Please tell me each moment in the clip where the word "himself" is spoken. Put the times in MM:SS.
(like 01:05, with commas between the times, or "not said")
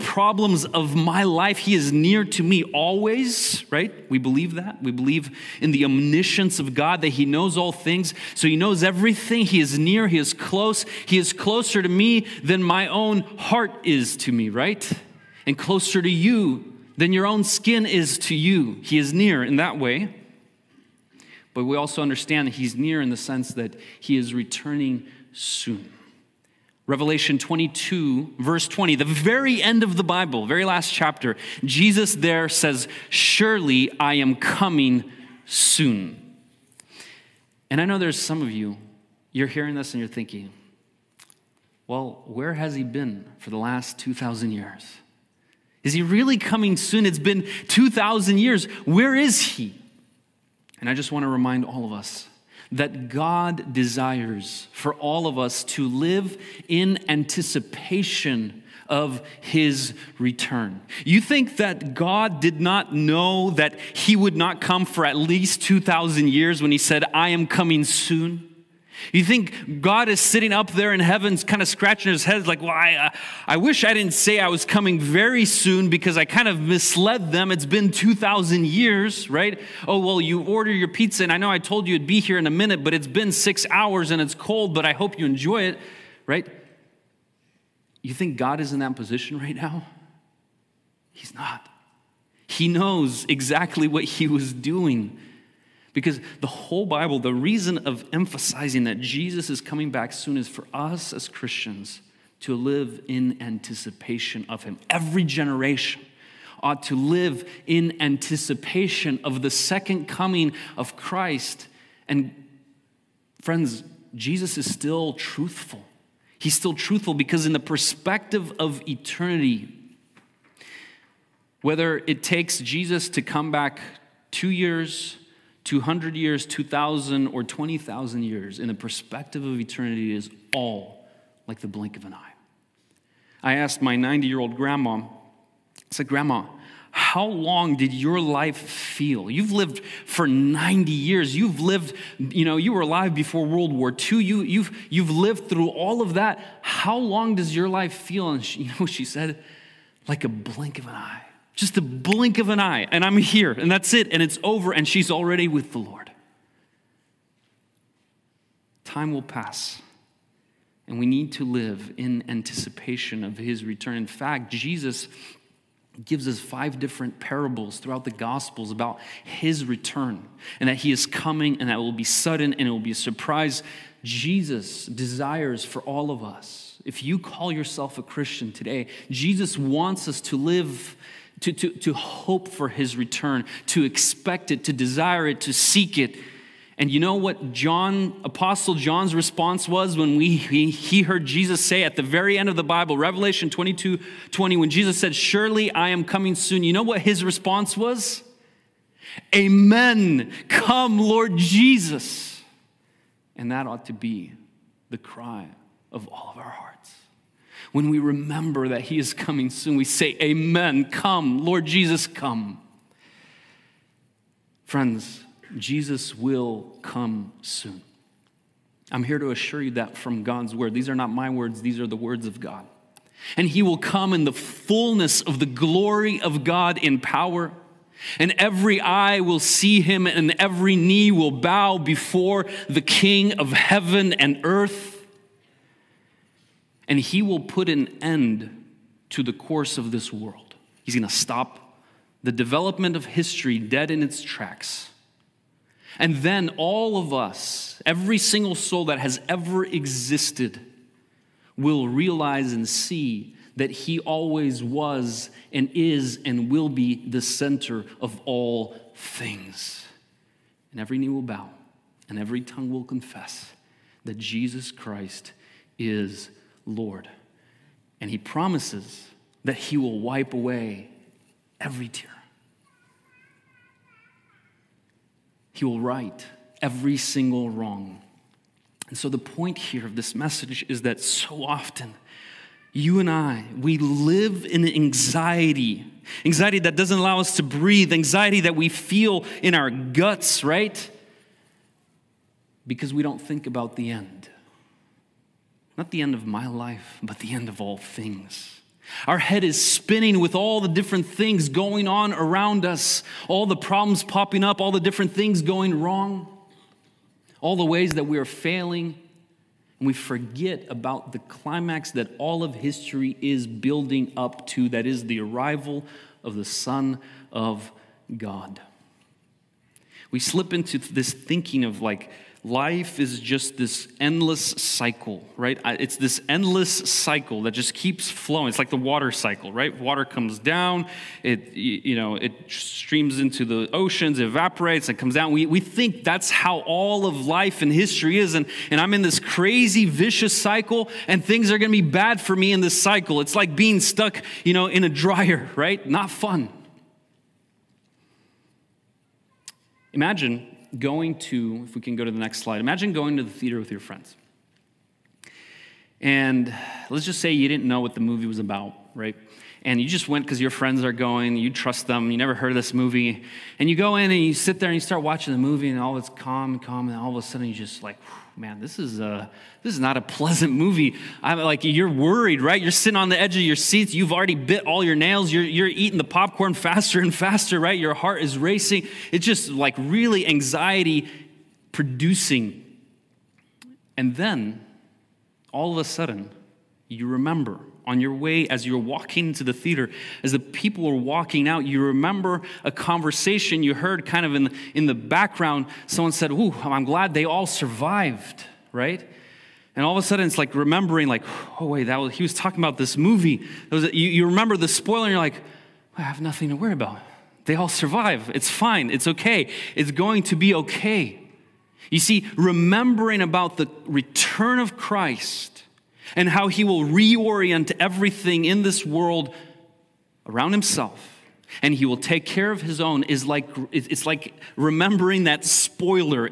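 07:00.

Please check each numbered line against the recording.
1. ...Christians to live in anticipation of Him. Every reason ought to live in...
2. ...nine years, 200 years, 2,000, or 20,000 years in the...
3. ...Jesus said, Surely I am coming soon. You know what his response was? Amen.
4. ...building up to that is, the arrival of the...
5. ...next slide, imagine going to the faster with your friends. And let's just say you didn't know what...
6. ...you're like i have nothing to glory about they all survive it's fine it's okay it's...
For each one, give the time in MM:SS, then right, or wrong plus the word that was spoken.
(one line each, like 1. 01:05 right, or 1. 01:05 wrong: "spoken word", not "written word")
1. 01:41 wrong: "generation", not "reason"
2. 02:04 wrong: "two", not "nine"
3. 03:14 right
4. 05:13 right
5. 05:52 wrong: "theater", not "faster"
6. 06:45 wrong: "worry", not "glory".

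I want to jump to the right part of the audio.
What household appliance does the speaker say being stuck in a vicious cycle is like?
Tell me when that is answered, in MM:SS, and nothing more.
05:44.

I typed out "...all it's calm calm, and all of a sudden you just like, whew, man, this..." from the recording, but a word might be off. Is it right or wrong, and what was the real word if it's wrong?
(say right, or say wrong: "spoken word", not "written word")
right.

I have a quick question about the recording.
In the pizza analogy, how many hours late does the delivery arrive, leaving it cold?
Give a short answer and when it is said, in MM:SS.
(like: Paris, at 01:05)
6 hours, at 01:23.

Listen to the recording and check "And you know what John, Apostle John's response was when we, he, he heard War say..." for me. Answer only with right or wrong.
wrong.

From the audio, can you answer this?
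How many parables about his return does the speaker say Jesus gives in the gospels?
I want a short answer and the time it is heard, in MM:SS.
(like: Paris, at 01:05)
5, at 02:46.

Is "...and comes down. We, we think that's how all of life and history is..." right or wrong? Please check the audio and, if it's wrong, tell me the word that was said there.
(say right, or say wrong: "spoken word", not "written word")
right.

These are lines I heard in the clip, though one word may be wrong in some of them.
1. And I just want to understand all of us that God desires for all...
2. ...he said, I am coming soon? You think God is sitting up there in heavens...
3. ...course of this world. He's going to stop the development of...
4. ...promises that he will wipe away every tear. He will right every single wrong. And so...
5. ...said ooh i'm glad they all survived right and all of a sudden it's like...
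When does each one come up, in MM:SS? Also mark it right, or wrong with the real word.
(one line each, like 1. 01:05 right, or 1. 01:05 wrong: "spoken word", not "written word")
1. 00:50 wrong: "remind", not "understand"
2. 01:06 right
3. 03:59 right
4. 04:28 right
5. 06:36 right.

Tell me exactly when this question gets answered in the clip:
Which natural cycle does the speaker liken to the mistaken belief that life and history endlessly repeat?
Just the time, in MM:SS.
05:28.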